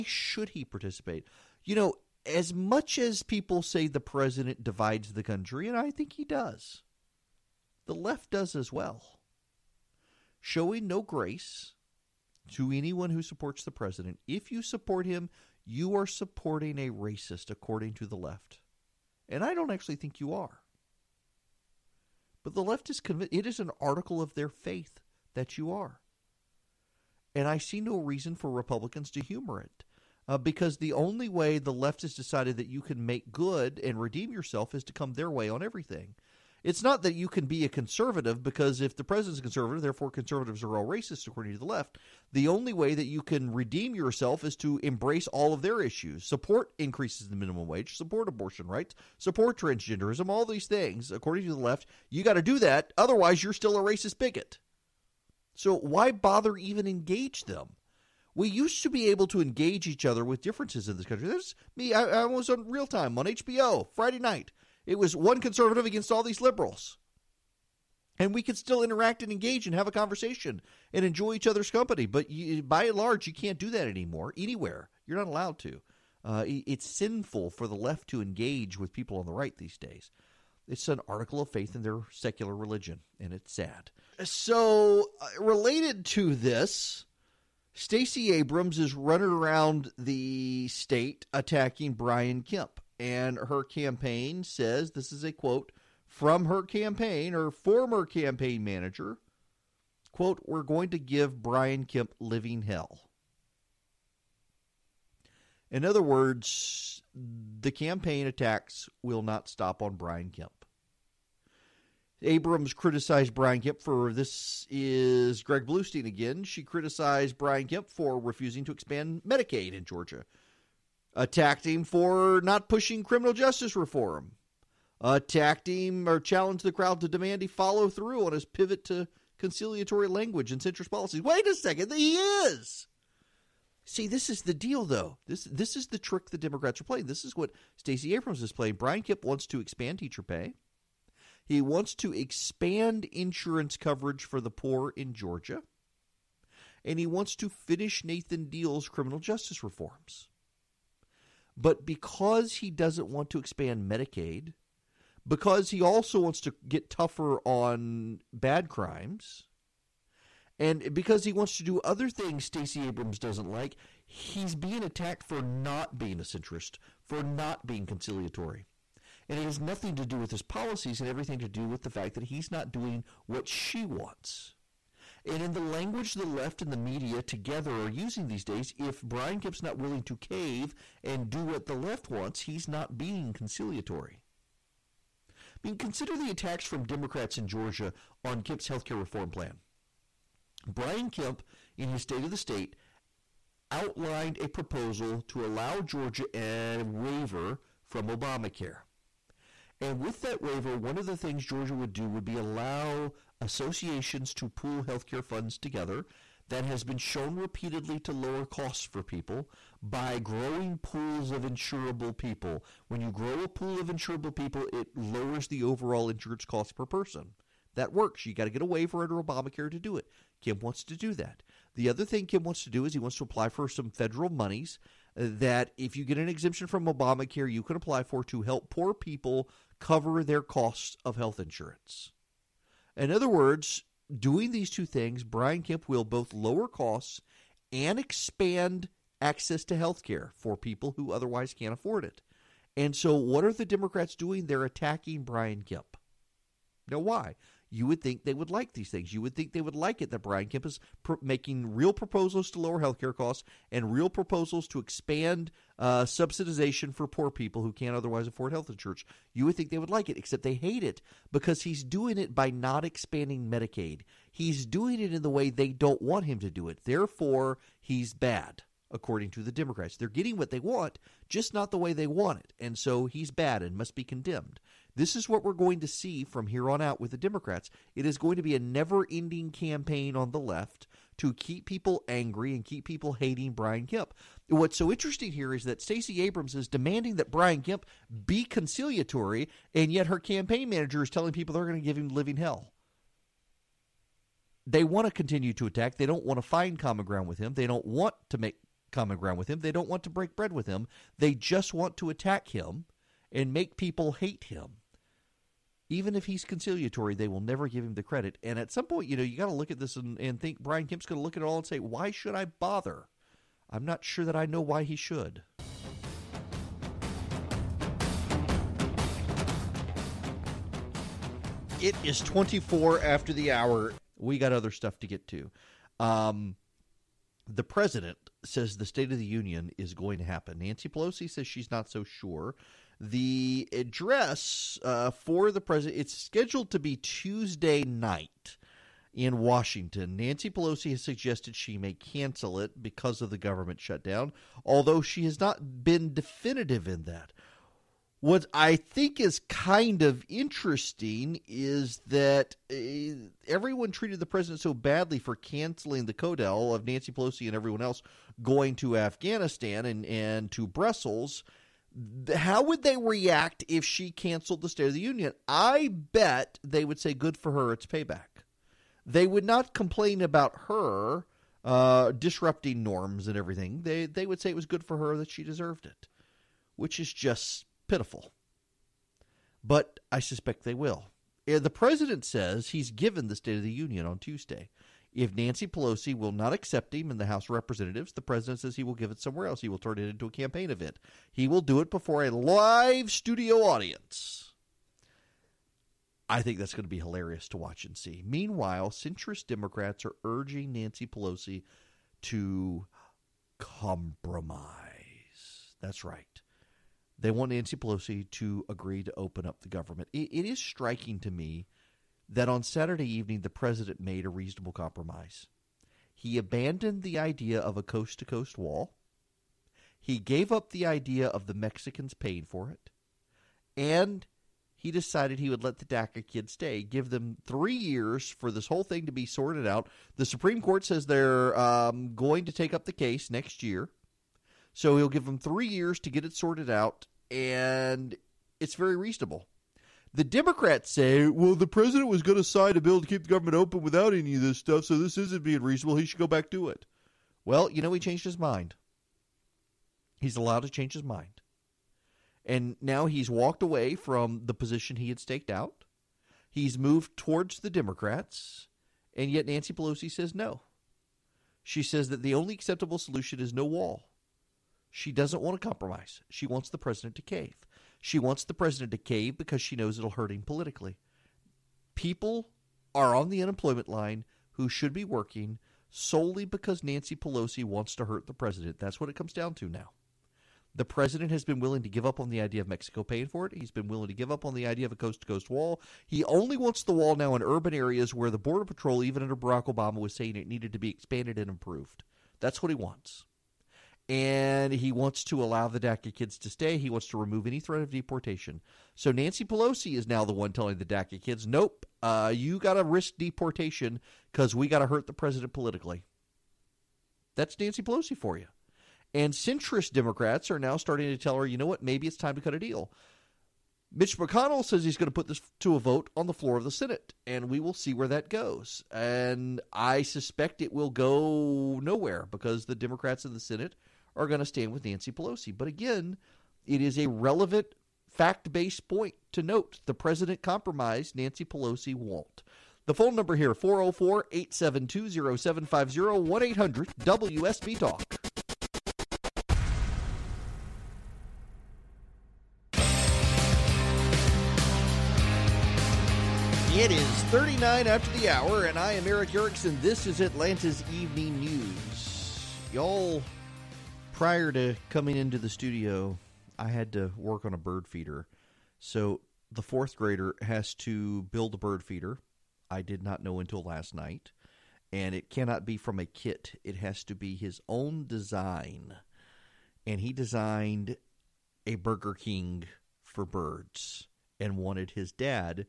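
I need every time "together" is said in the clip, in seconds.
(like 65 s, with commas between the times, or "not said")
177 s, 205 s.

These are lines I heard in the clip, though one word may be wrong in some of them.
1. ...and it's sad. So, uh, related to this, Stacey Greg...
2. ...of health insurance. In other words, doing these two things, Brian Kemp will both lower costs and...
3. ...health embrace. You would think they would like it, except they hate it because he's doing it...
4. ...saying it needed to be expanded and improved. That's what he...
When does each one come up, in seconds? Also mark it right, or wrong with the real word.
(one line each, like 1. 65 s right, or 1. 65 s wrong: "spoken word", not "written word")
1. 83 s wrong: "Abrams", not "Greg"
2. 231 s right
3. 258 s wrong: "insurance", not "embrace"
4. 490 s right.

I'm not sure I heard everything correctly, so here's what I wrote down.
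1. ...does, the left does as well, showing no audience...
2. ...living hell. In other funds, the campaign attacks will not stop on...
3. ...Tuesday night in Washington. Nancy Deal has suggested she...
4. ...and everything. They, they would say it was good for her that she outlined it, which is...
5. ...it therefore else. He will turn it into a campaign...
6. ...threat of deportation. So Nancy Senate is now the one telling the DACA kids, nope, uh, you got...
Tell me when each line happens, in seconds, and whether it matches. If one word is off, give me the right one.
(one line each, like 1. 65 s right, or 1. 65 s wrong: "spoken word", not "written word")
1. 6 s wrong: "grace", not "audience"
2. 102 s wrong: "words", not "funds"
3. 336 s wrong: "Pelosi", not "Deal"
4. 373 s wrong: "deserved", not "outlined"
5. 389 s wrong: "somewhere", not "therefore"
6. 497 s wrong: "Pelosi", not "Senate".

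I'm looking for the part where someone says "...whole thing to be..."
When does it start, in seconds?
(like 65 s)
428 s.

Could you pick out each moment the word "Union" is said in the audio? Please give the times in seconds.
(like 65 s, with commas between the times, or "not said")
329 s, 364 s, 383 s.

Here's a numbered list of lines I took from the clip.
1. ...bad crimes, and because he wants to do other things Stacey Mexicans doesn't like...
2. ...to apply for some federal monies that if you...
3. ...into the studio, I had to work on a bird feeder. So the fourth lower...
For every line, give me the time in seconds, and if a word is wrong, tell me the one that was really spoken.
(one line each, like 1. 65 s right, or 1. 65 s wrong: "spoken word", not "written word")
1. 158 s wrong: "Abrams", not "Mexicans"
2. 223 s right
3. 555 s wrong: "grader", not "lower".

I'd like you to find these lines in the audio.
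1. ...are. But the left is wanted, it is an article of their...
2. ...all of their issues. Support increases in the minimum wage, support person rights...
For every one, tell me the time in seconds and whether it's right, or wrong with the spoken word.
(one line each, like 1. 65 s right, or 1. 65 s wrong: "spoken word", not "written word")
1. 20 s wrong: "convinced", not "wanted"
2. 45 s wrong: "abortion", not "person".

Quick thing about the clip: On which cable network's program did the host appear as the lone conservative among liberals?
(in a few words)
HBO.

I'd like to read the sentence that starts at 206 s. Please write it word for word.
That has been shown repeatedly to lower costs for people by growing pools of insurable people.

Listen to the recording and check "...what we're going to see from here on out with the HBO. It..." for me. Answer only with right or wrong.
wrong.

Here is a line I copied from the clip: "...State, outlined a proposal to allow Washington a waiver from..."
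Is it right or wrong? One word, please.
wrong.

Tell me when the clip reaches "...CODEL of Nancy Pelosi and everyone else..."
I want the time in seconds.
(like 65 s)
356 s.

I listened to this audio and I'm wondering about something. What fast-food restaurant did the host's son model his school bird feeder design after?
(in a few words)
Burger King.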